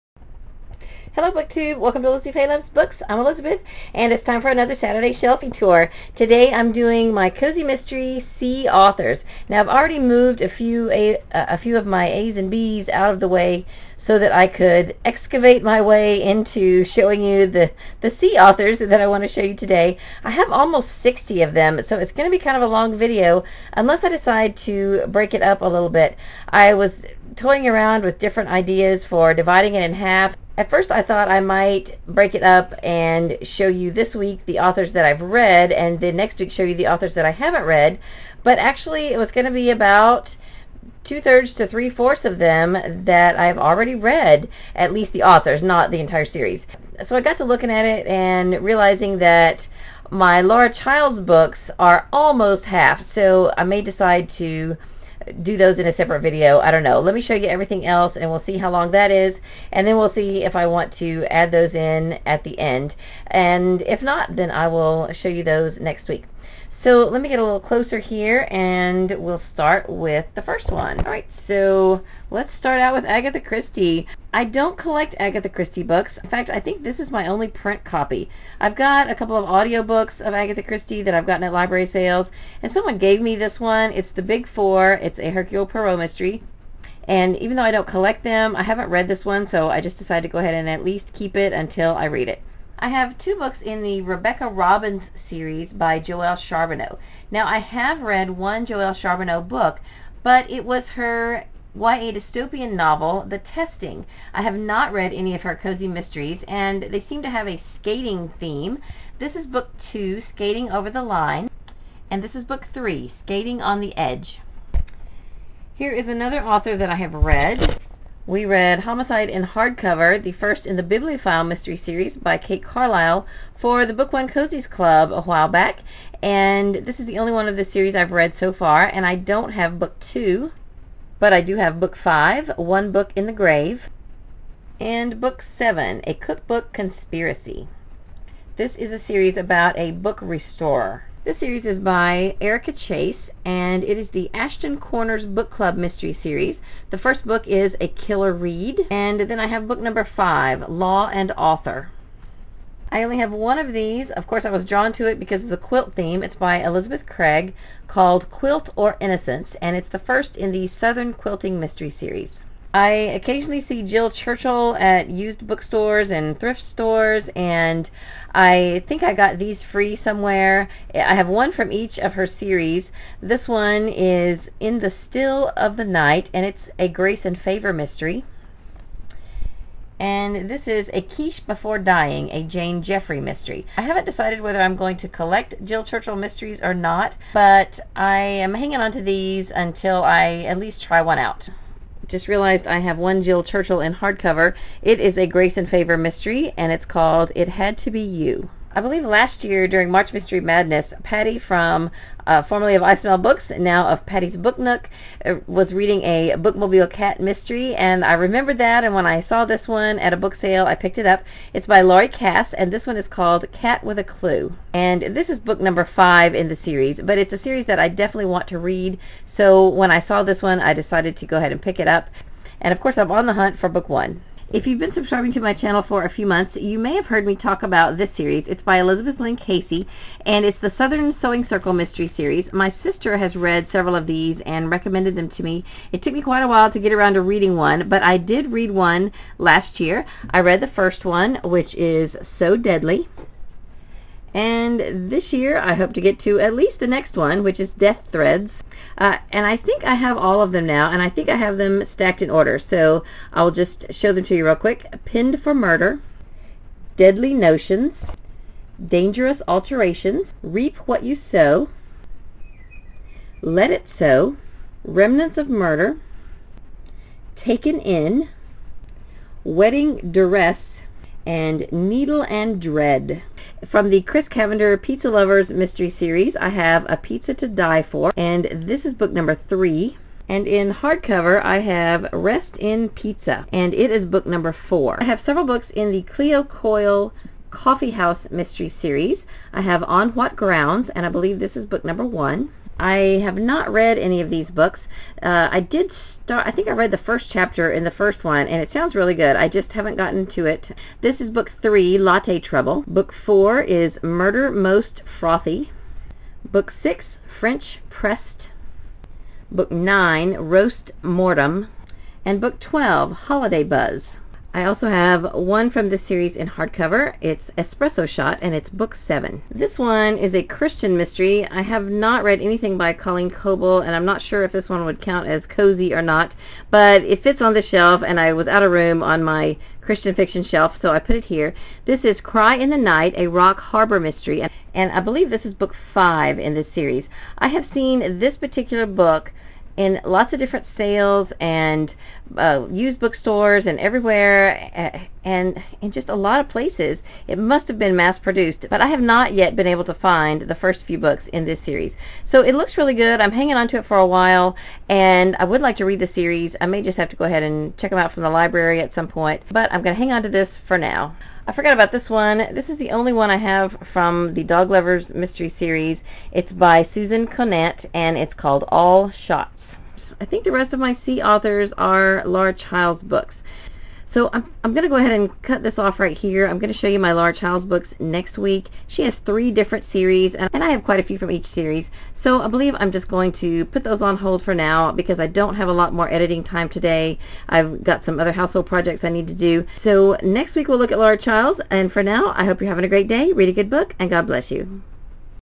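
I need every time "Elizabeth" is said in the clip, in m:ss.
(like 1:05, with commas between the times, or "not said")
0:03, 2:36, 3:48.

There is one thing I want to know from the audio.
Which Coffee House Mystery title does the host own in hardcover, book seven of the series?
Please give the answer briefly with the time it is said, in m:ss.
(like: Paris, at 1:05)
Espresso Shot, at 5:17.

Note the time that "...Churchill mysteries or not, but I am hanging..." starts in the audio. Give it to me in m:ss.
3:05.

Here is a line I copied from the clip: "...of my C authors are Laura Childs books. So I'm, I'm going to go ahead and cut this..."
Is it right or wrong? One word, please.
right.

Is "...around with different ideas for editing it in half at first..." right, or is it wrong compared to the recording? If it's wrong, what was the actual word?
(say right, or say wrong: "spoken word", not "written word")
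wrong: "dividing", not "editing".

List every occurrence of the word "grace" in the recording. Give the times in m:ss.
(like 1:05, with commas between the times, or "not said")
2:56, 3:15.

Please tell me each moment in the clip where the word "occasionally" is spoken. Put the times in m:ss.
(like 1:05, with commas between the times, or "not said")
2:42.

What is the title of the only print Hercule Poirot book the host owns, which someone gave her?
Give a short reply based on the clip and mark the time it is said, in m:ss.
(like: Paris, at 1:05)
The Big Four, at 1:24.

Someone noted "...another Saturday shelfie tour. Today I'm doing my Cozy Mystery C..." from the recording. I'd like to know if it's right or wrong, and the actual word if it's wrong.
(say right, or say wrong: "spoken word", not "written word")
right.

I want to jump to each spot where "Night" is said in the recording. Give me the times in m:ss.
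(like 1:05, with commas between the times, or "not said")
2:55, 5:32.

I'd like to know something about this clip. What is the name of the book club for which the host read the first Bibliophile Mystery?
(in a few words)
Book One Cozies Club.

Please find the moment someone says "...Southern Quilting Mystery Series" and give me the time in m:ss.
2:40.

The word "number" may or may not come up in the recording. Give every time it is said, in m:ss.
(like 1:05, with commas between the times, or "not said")
2:29, 3:35, 4:39, 4:44, 4:51.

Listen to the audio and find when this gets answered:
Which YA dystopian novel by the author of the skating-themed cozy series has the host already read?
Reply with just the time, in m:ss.
1:43.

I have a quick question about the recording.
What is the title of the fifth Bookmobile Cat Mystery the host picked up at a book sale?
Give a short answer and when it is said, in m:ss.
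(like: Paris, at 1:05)
Cat with a Clue, at 3:33.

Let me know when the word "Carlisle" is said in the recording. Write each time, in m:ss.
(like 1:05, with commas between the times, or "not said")
2:02.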